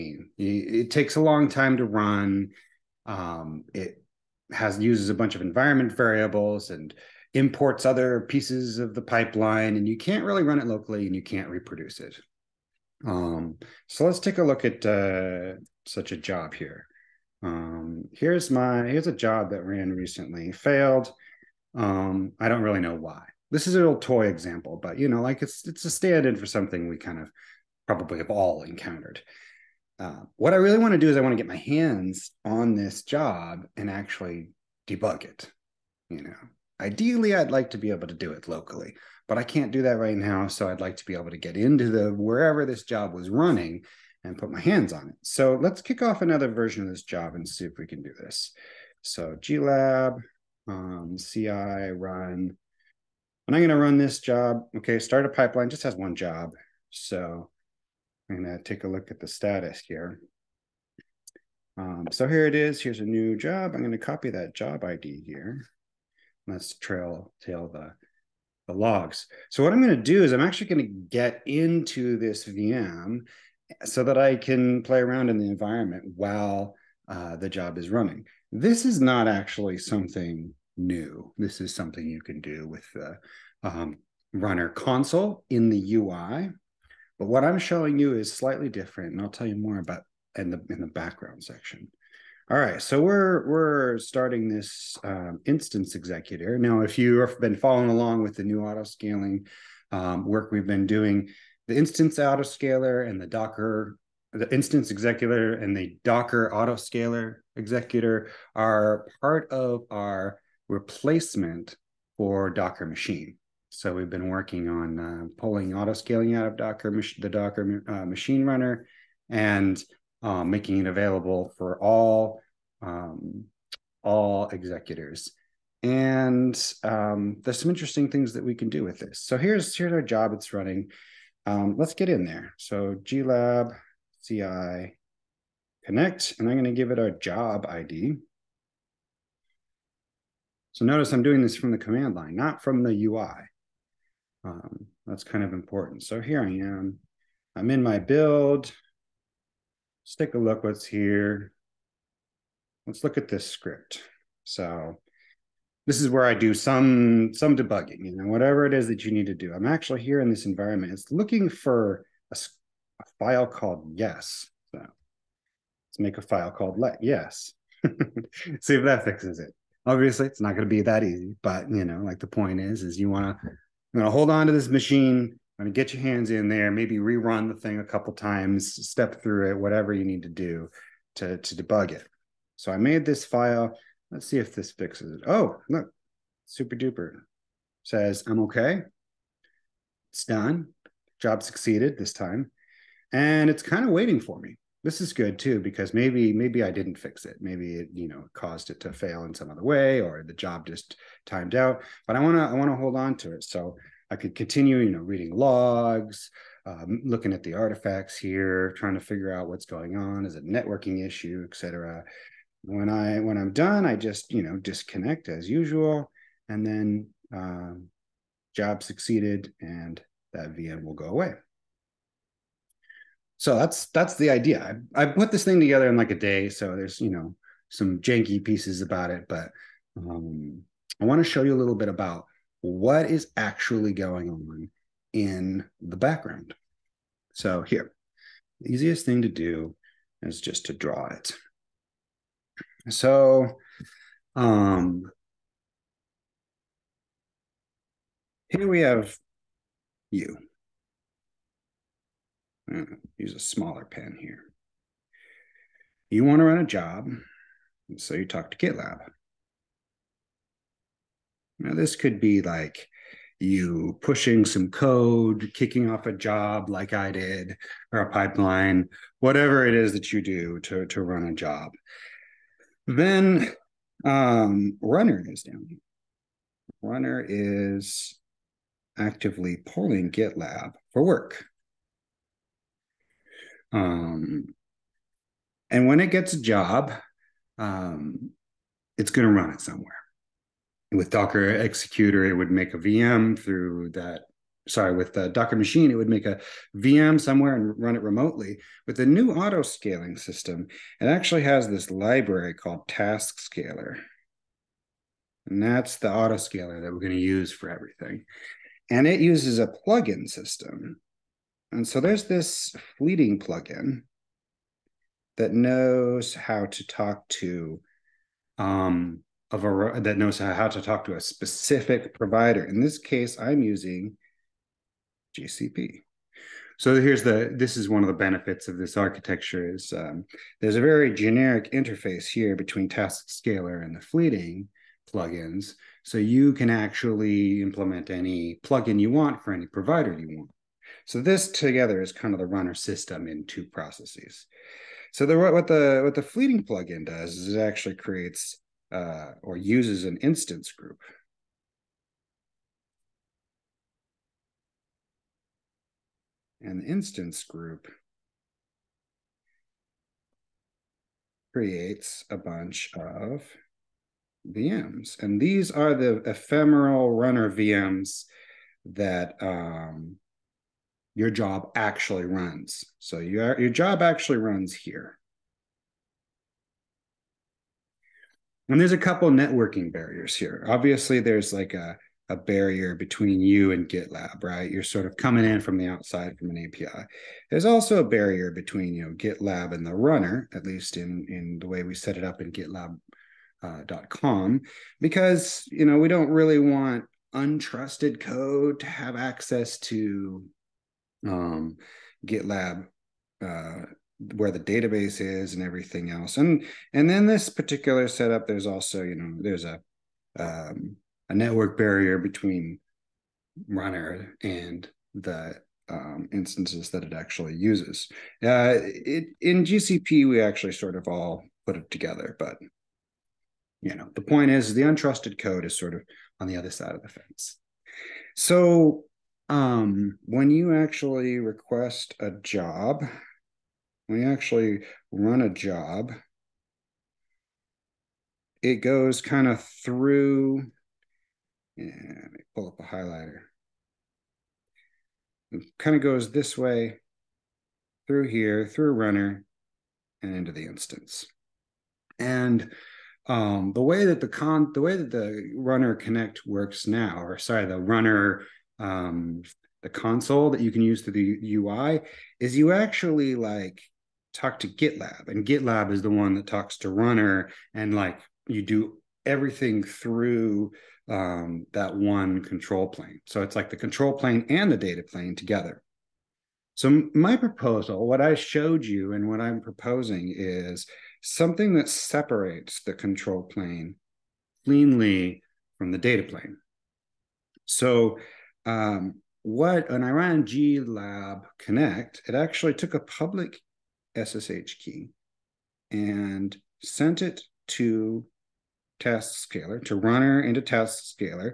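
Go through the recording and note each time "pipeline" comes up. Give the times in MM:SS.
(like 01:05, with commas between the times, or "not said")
00:09, 00:55, 04:28.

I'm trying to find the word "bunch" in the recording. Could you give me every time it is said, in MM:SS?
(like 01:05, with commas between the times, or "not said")
00:05, 06:02.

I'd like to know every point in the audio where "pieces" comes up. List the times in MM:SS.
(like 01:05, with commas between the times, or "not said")
00:08, 03:48.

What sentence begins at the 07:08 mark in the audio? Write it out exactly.
So um, when you actually request a job we actually run a job, it goes kind of through.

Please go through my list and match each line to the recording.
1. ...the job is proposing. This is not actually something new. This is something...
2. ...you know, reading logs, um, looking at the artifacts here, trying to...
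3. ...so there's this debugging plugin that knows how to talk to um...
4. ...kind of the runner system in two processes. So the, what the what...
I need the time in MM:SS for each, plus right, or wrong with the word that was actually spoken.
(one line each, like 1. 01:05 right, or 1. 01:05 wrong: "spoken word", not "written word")
1. 01:17 wrong: "running", not "proposing"
2. 03:24 right
3. 05:11 wrong: "fleeting", not "debugging"
4. 05:42 right.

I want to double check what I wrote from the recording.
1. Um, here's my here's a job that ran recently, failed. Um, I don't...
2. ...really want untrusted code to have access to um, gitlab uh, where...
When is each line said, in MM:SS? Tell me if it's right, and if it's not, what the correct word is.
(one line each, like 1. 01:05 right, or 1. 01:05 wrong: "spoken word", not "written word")
1. 00:17 right
2. 06:36 right.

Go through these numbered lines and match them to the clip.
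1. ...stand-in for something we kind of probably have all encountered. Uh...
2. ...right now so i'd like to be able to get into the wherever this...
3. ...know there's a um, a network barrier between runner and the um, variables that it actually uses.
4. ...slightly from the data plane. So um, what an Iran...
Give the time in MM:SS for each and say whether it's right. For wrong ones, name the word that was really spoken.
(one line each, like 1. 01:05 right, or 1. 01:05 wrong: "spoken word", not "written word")
1. 00:25 right
2. 00:39 right
3. 06:49 wrong: "instances", not "variables"
4. 08:04 wrong: "cleanly", not "slightly".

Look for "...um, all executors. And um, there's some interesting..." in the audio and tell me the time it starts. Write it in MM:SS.
02:02.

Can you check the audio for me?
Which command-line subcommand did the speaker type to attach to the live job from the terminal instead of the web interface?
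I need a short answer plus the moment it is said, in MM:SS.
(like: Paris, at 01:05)
glab ci connect, at 02:13.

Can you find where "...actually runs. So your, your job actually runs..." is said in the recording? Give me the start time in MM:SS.
06:11.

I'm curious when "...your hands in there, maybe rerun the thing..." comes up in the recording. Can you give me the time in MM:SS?
02:55.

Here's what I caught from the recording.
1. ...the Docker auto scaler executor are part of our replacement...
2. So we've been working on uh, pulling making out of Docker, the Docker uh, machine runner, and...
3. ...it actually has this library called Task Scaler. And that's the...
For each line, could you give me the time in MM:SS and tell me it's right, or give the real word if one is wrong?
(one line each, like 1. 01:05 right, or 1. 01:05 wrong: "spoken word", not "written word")
1. 01:45 right
2. 01:53 wrong: "scaling", not "making"
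3. 05:00 right.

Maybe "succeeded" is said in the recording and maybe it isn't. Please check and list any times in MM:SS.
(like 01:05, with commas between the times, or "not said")
03:11, 03:38.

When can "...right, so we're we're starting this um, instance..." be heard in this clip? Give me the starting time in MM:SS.
01:32.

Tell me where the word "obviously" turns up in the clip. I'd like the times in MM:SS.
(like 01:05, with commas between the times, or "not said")
02:49, 06:20.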